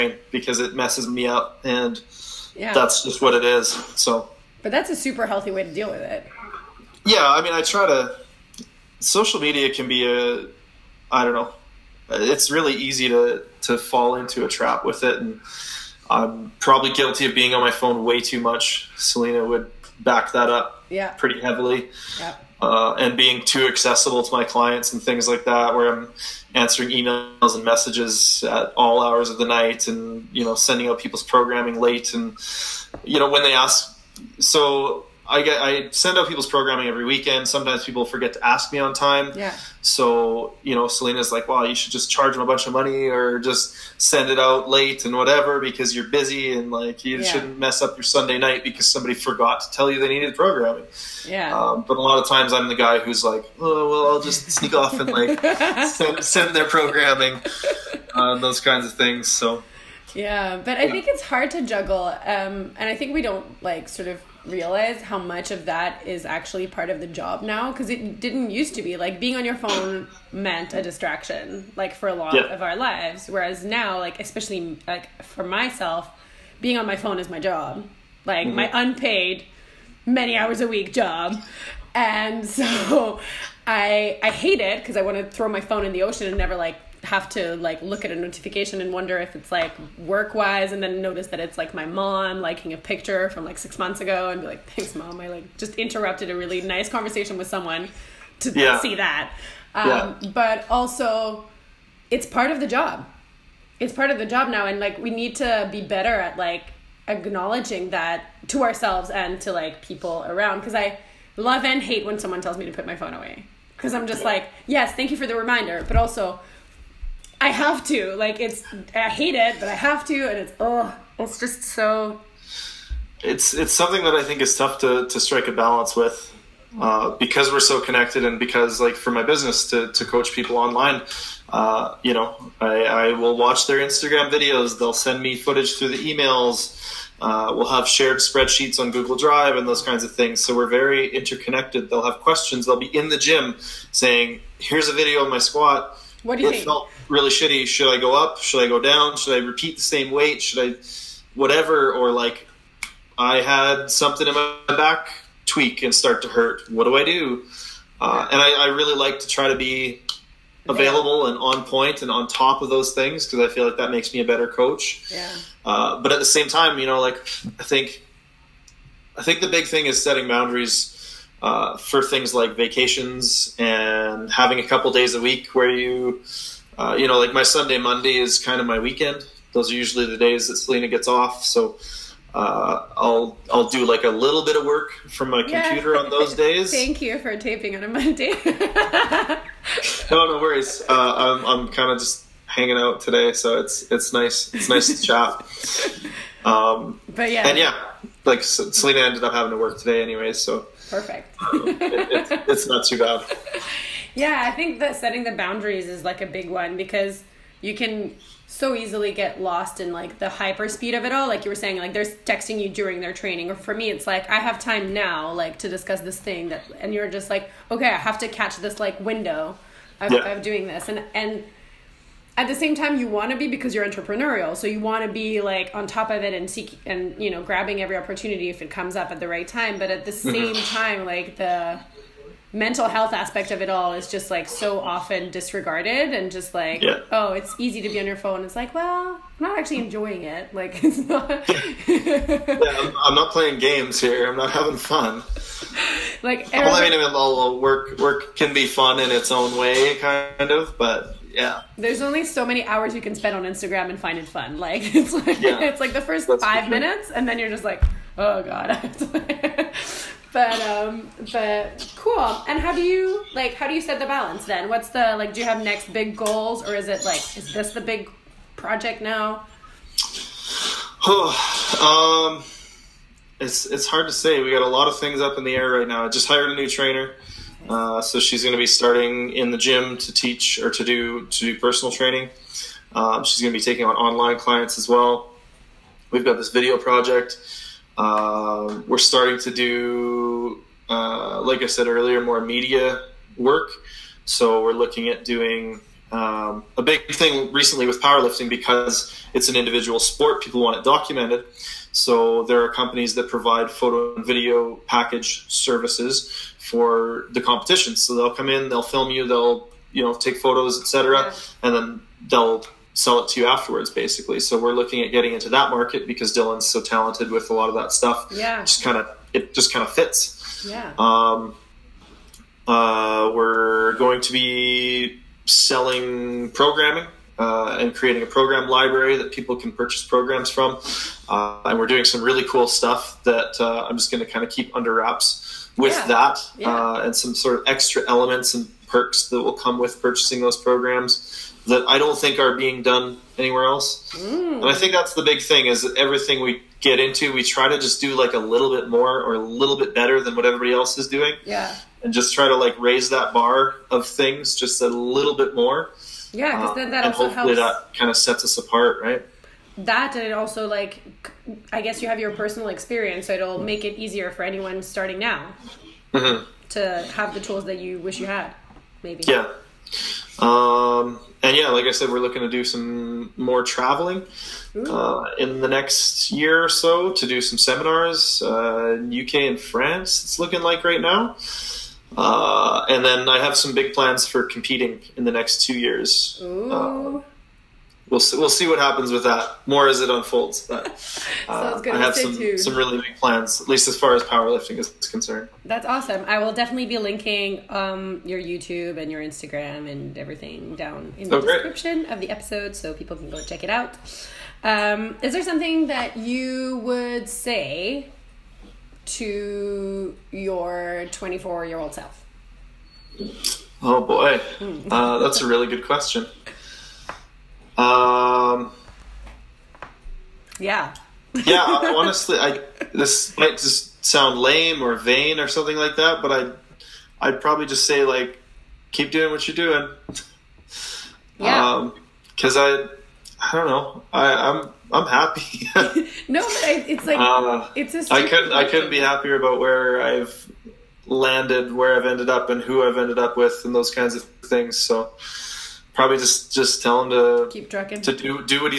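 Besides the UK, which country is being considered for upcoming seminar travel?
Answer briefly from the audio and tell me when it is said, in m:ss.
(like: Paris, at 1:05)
France, at 6:19.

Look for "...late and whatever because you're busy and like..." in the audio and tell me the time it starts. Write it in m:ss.
0:44.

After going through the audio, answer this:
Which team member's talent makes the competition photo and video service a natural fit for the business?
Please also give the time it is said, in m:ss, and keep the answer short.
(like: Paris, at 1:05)
Dylan, at 5:16.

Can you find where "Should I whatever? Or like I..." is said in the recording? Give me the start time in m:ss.
2:30.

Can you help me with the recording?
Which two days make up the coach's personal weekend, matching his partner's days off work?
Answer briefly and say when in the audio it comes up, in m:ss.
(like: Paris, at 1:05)
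Sunday, Monday, at 2:57.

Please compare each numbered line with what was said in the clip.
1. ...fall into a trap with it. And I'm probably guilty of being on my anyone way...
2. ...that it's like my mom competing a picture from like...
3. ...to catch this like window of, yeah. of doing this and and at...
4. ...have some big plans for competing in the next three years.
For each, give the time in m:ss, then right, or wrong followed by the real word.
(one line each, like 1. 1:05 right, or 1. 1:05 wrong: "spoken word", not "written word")
1. 0:13 wrong: "phone", not "anyone"
2. 1:31 wrong: "liking", not "competing"
3. 3:38 right
4. 6:23 wrong: "two", not "three".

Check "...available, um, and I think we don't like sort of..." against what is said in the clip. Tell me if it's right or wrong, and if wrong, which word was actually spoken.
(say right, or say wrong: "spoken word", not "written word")
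wrong: "juggle", not "available".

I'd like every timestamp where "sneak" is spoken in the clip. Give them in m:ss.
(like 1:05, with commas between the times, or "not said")
0:54.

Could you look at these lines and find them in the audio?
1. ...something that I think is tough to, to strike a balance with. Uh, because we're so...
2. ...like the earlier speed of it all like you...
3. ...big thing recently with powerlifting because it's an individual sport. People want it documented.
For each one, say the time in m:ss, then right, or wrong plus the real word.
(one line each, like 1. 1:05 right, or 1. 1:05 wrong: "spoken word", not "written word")
1. 2:03 right
2. 3:29 wrong: "hyper", not "earlier"
3. 4:56 right.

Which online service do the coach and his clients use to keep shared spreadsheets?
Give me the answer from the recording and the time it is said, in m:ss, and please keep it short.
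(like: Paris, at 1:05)
Google Drive, at 2:18.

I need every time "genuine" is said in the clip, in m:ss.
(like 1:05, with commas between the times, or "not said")
not said.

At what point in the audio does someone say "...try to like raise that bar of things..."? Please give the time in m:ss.
5:52.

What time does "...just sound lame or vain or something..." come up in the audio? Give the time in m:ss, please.
7:03.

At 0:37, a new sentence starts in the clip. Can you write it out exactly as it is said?
Sometimes people forget to ask me on time.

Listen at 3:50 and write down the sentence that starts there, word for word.
same time like the mental health aspect of it all is just like so often disregarded and just like yeah.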